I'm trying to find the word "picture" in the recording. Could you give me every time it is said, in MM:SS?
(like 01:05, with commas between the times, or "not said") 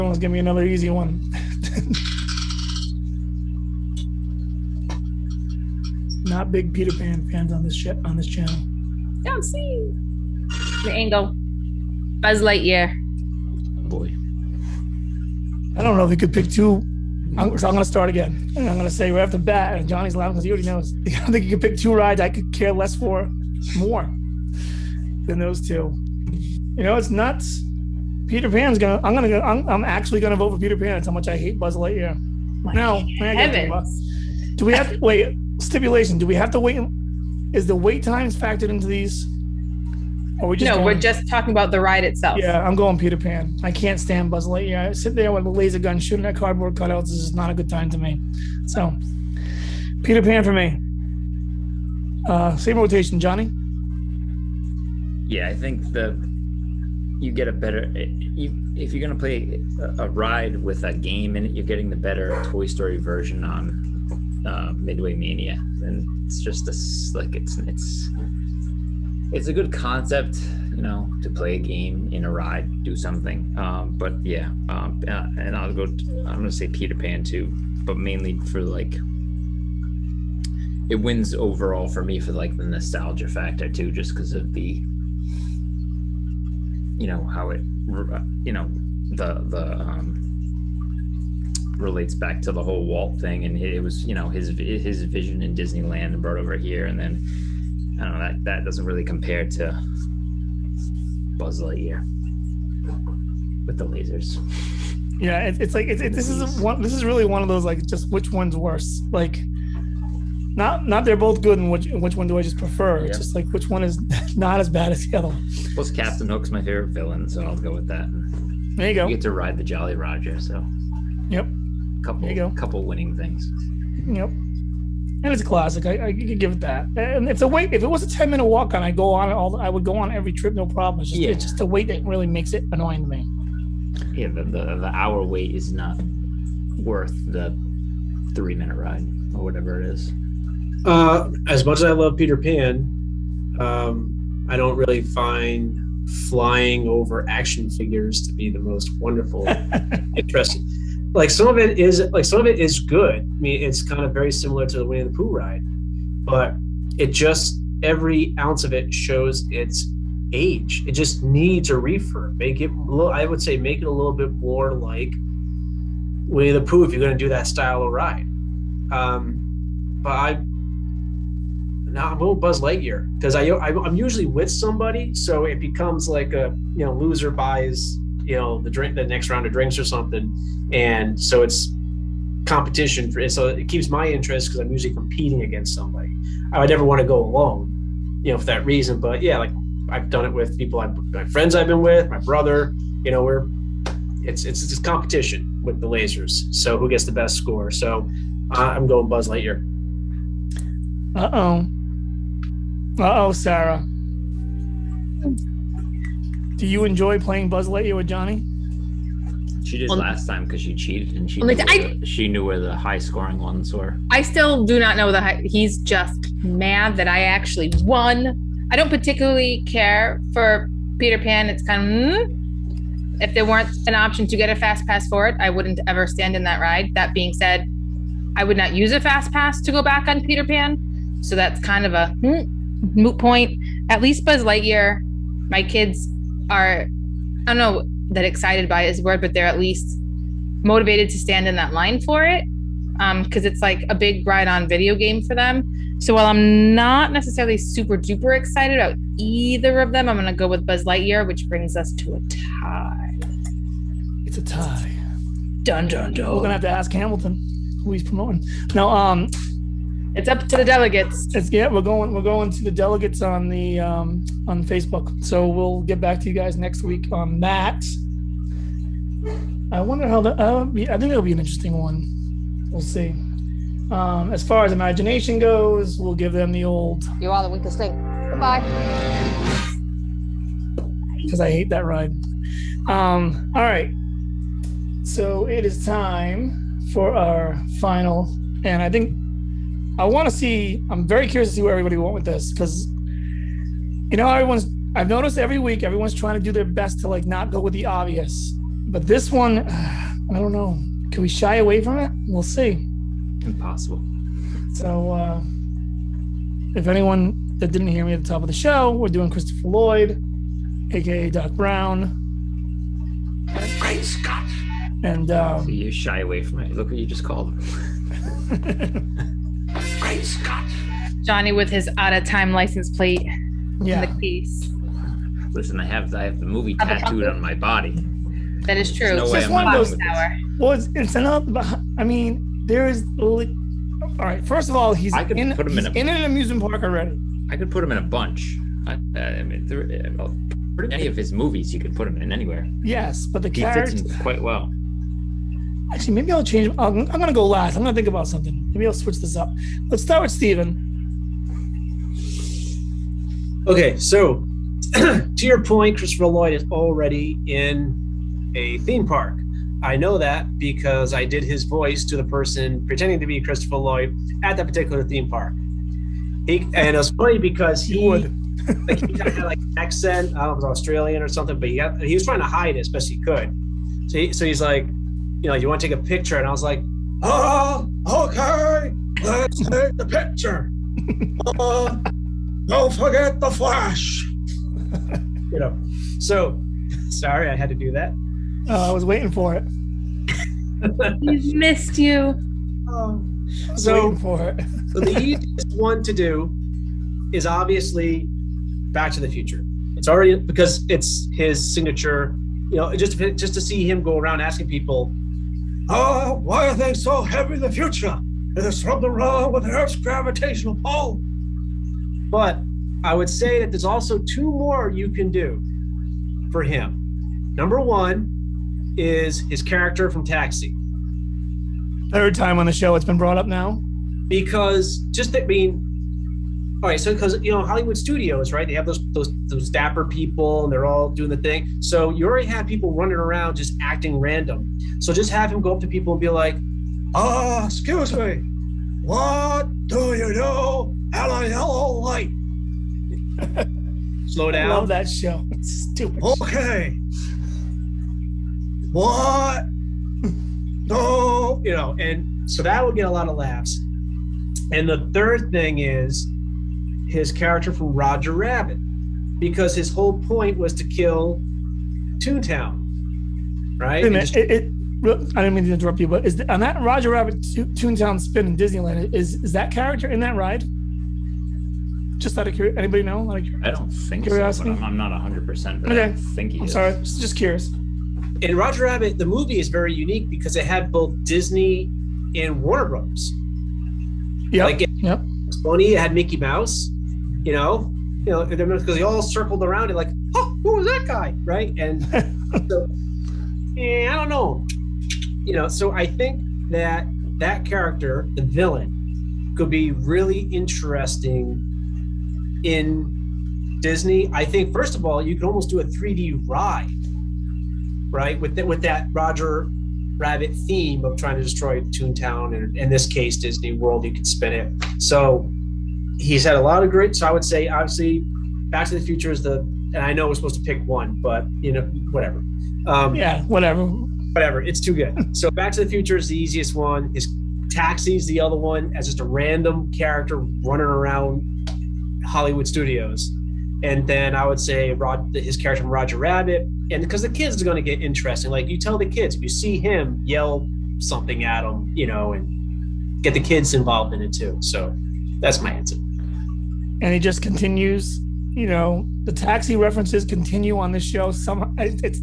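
06:16, 06:20.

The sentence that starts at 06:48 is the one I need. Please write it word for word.
It is something wrong with Earth's gravitational pull.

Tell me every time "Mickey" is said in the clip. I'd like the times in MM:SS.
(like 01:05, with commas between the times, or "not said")
08:06.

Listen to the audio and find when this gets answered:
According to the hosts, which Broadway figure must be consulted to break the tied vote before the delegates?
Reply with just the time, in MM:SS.
04:16.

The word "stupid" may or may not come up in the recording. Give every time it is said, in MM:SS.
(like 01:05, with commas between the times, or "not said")
07:25.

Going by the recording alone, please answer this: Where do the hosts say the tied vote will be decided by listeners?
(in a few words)
Facebook.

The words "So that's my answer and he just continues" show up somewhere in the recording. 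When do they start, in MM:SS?
09:04.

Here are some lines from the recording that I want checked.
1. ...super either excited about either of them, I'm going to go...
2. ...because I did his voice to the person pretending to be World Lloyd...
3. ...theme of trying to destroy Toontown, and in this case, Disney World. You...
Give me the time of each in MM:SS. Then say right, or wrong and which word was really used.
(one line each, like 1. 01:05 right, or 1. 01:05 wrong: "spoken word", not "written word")
1. 04:07 wrong: "duper", not "either"
2. 06:00 wrong: "Christopher", not "World"
3. 08:30 right.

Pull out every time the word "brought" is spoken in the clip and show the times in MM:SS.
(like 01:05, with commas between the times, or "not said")
01:36, 07:03.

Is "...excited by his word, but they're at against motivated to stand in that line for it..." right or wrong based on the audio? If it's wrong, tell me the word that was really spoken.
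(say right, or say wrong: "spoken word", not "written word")
wrong: "least", not "against".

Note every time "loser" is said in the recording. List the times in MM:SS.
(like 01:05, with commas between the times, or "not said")
02:56.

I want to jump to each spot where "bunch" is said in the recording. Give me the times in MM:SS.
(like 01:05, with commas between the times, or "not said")
05:38.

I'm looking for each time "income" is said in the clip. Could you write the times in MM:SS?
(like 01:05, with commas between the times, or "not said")
not said.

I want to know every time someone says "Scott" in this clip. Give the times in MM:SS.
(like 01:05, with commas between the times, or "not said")
05:14, 05:20.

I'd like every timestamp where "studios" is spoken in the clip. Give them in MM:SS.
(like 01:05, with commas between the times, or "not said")
07:07, 08:52.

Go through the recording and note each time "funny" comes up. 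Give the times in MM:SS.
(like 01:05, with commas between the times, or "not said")
06:07, 08:05.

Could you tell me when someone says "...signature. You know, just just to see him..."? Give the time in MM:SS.
06:41.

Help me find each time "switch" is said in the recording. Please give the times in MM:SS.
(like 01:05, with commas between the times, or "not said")
05:48.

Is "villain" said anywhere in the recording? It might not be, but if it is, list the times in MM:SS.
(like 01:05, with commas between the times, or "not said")
01:56, 08:18.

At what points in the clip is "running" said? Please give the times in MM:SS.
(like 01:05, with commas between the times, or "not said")
07:12, 08:50.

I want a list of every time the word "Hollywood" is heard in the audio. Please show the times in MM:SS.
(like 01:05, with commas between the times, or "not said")
07:07, 08:52.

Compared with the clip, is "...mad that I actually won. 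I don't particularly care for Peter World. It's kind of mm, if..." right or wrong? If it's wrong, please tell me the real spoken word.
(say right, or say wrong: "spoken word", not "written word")
wrong: "Pan", not "World".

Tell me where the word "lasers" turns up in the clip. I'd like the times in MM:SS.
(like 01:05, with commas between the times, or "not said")
00:45, 01:43, 03:15.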